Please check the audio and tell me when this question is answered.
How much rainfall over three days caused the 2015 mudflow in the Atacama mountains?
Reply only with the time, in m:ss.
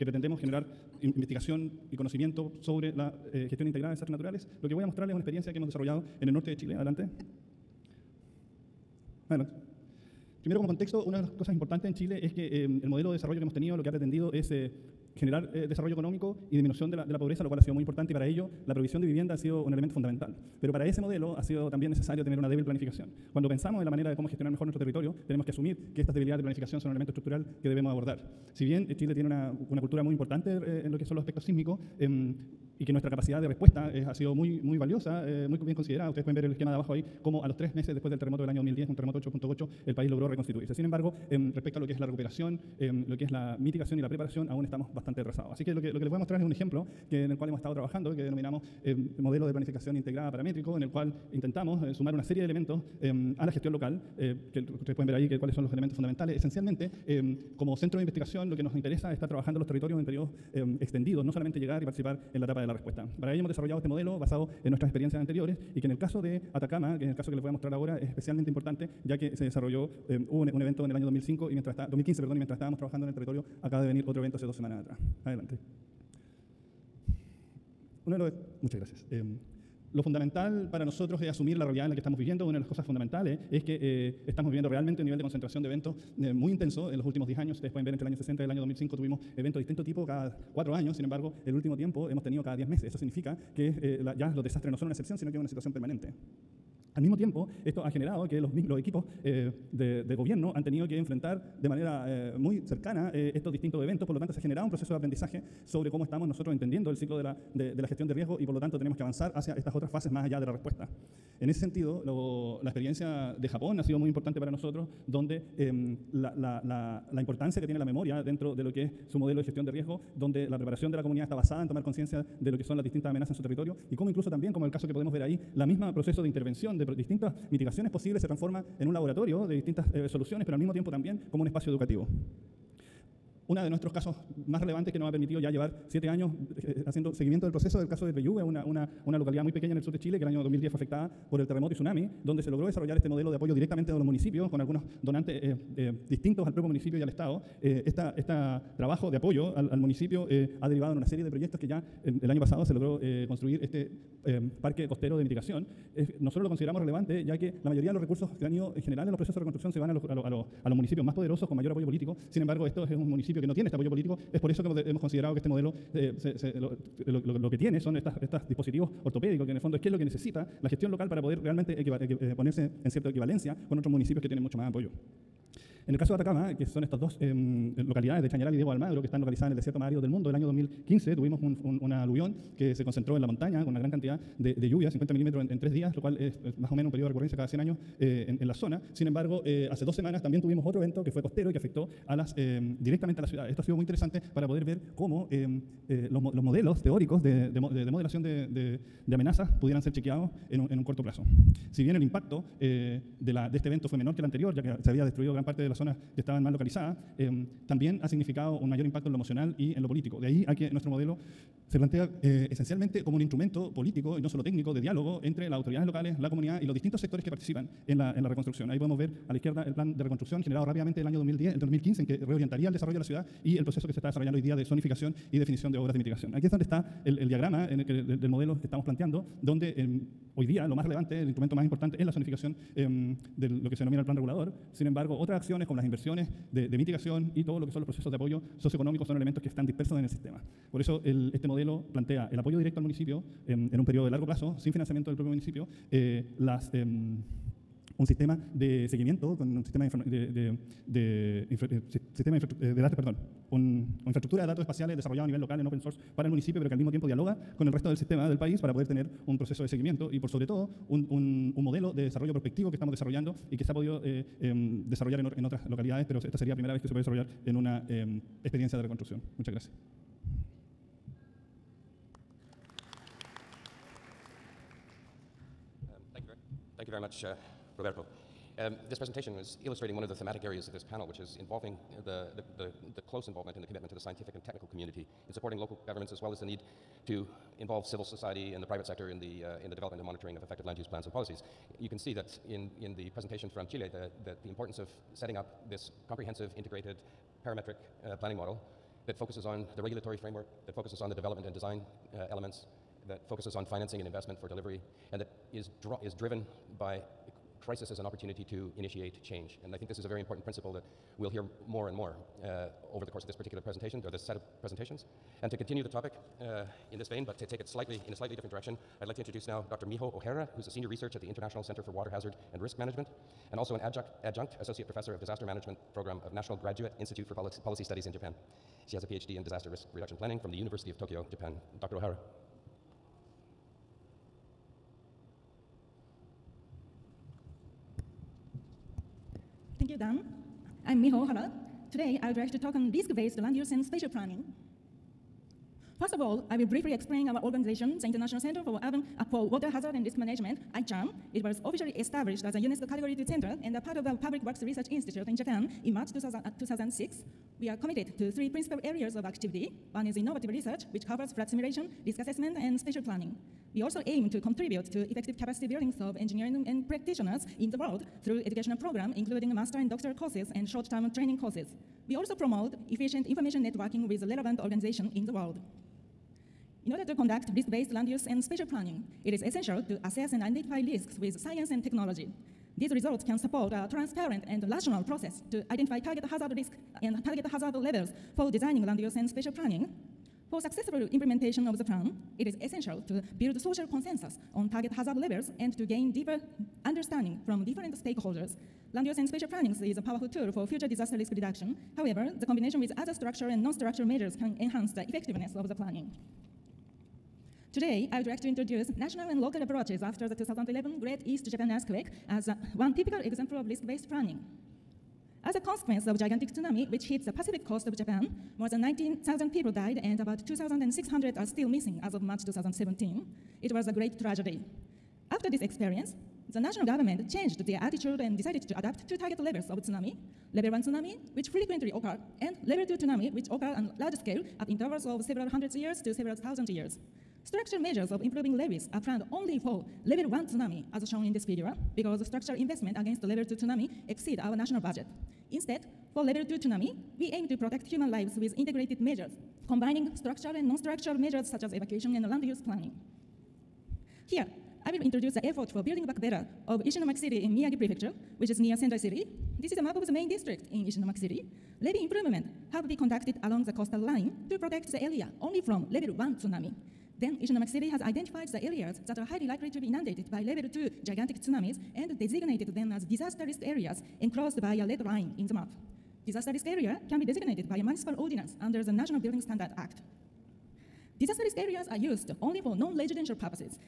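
3:04.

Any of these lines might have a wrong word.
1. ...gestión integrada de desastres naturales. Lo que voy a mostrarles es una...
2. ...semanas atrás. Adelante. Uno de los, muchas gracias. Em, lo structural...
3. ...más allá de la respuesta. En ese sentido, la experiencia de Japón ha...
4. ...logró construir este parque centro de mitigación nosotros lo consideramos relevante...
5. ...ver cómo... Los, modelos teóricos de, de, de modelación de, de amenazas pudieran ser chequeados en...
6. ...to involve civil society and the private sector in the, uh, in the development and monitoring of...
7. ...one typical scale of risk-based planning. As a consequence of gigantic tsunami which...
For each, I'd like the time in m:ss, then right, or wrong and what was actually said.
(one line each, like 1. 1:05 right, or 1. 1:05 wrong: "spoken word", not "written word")
1. 0:03 right
2. 1:14 wrong: "fundamental", not "structural"
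3. 1:50 right
4. 2:32 wrong: "costero", not "centro"
5. 3:14 right
6. 4:47 right
7. 6:52 wrong: "example", not "scale".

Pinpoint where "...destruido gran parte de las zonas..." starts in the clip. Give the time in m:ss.
3:25.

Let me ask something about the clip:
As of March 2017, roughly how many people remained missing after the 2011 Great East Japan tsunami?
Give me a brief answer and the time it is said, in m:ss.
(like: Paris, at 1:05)
2,600, at 7:00.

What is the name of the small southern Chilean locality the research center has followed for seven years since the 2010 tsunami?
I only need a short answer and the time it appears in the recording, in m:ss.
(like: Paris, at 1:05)
Treyúgue, at 2:18.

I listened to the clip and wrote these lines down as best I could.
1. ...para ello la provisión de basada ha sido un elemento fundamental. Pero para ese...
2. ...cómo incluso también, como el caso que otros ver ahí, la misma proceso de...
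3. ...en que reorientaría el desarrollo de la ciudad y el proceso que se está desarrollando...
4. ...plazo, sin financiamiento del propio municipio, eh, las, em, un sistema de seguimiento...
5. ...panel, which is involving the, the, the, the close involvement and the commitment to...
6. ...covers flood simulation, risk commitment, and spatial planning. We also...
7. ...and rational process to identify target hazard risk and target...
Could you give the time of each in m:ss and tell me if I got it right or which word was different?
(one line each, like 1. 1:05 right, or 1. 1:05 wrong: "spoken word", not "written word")
1. 0:18 wrong: "vivienda", not "basada"
2. 2:03 wrong: "podemos", not "otros"
3. 3:42 right
4. 4:04 right
5. 4:40 right
6. 6:01 wrong: "assessment", not "commitment"
7. 6:24 right.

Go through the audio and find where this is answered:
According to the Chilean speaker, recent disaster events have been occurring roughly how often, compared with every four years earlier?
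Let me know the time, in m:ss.
1:32.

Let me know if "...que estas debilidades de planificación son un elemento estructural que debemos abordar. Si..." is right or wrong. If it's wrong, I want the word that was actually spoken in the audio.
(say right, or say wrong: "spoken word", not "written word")
right.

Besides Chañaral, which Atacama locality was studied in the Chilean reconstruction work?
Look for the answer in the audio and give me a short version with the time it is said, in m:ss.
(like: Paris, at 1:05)
Diego Almagro, at 2:58.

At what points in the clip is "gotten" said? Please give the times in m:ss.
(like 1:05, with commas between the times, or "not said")
not said.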